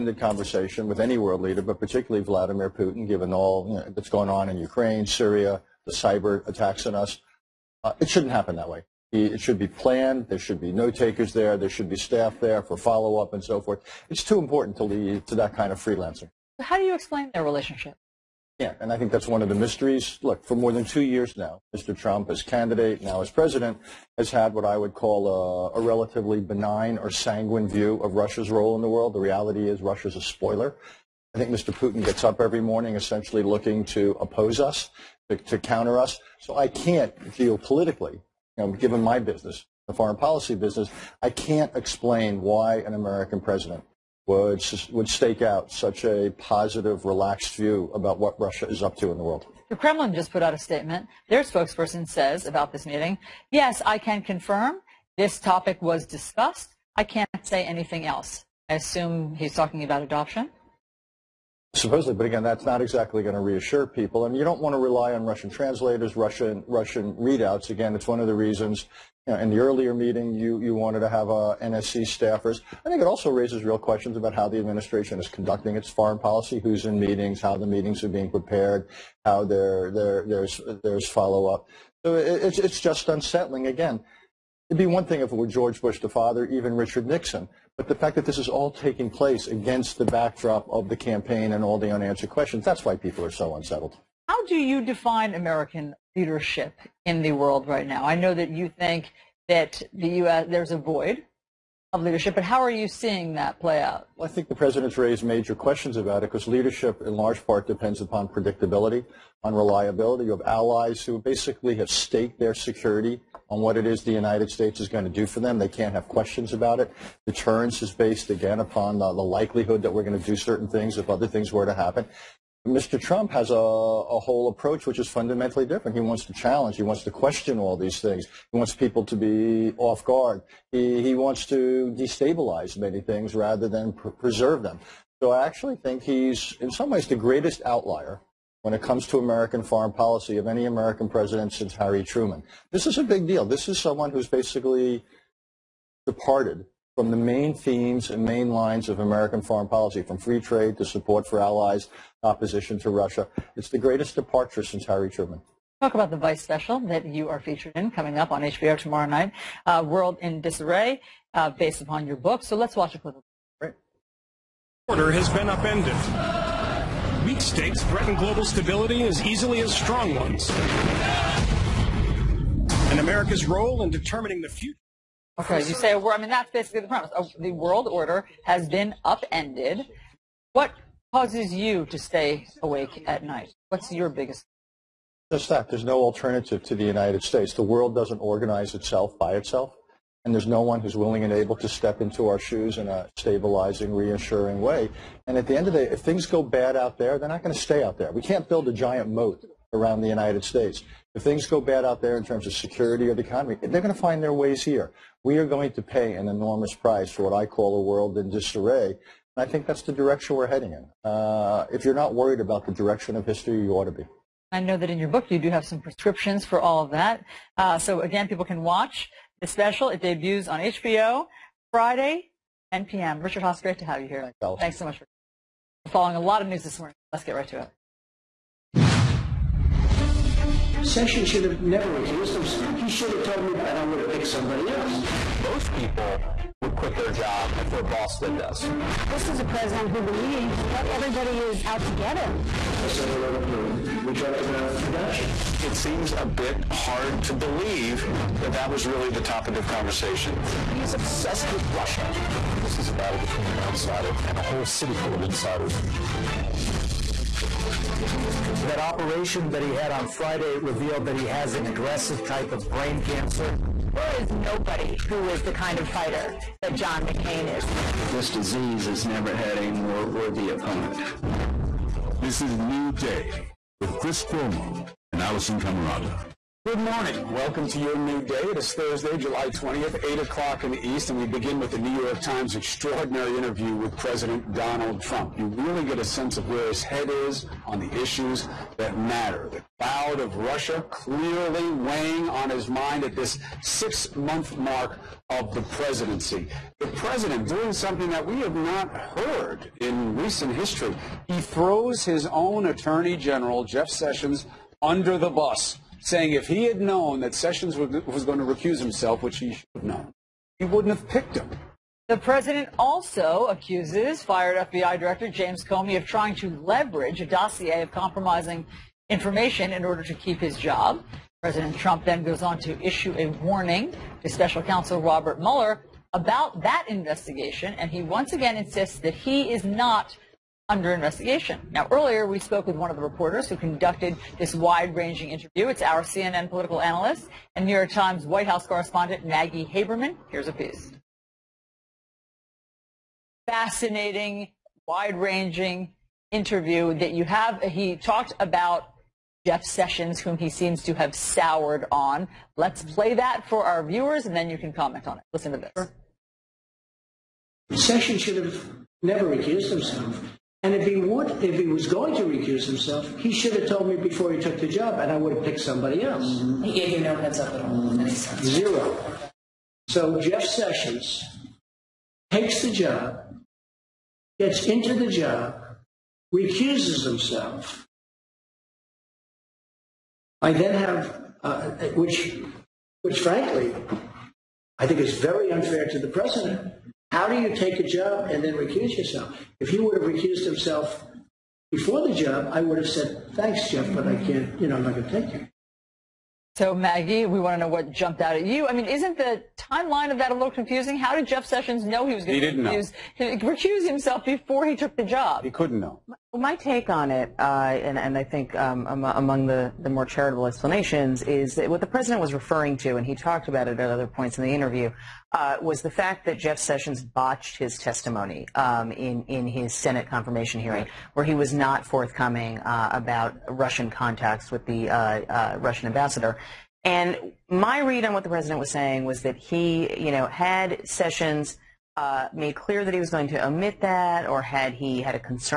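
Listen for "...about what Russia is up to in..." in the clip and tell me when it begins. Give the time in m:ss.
0:47.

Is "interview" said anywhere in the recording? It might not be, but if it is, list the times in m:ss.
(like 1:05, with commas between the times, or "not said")
4:43, 5:35, 5:46, 6:54.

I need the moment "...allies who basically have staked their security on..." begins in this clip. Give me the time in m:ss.
1:50.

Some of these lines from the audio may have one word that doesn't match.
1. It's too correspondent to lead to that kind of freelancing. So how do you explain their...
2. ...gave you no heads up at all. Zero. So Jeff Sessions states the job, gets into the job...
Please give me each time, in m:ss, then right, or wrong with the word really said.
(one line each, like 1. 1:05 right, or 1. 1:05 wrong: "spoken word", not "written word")
1. 0:14 wrong: "important", not "correspondent"
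2. 6:06 wrong: "takes", not "states".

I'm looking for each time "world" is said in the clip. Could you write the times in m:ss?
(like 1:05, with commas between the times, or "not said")
0:01, 0:28, 0:49, 1:37, 2:39, 2:57, 3:07, 3:27.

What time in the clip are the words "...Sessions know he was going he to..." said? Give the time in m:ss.
6:41.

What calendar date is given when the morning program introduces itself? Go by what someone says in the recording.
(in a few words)
July 20th.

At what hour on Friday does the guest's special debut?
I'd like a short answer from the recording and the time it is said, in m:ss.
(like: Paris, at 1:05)
10 p.m., at 3:42.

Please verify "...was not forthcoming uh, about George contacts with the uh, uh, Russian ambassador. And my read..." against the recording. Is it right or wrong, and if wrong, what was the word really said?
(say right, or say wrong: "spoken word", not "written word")
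wrong: "Russian", not "George".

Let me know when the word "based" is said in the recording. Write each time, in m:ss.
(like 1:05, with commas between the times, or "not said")
1:57, 2:41.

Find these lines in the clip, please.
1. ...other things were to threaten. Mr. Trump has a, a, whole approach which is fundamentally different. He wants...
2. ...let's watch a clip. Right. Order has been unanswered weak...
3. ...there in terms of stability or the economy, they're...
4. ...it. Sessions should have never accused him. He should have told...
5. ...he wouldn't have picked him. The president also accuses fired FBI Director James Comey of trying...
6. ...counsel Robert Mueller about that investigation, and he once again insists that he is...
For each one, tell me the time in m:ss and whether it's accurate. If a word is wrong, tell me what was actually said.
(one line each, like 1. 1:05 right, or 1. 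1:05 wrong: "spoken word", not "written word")
1. 2:01 wrong: "happen", not "threaten"
2. 2:42 wrong: "upended", not "unanswered"
3. 3:22 wrong: "security", not "stability"
4. 3:47 right
5. 5:10 right
6. 5:24 right.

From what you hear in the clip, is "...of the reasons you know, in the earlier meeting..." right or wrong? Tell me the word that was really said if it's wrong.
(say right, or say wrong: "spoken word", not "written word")
right.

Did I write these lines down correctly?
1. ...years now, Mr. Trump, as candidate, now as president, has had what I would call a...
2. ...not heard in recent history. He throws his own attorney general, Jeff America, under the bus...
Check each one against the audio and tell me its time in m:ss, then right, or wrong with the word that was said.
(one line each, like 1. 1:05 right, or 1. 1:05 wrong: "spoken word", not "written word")
1. 0:21 right
2. 4:58 wrong: "Sessions", not "America".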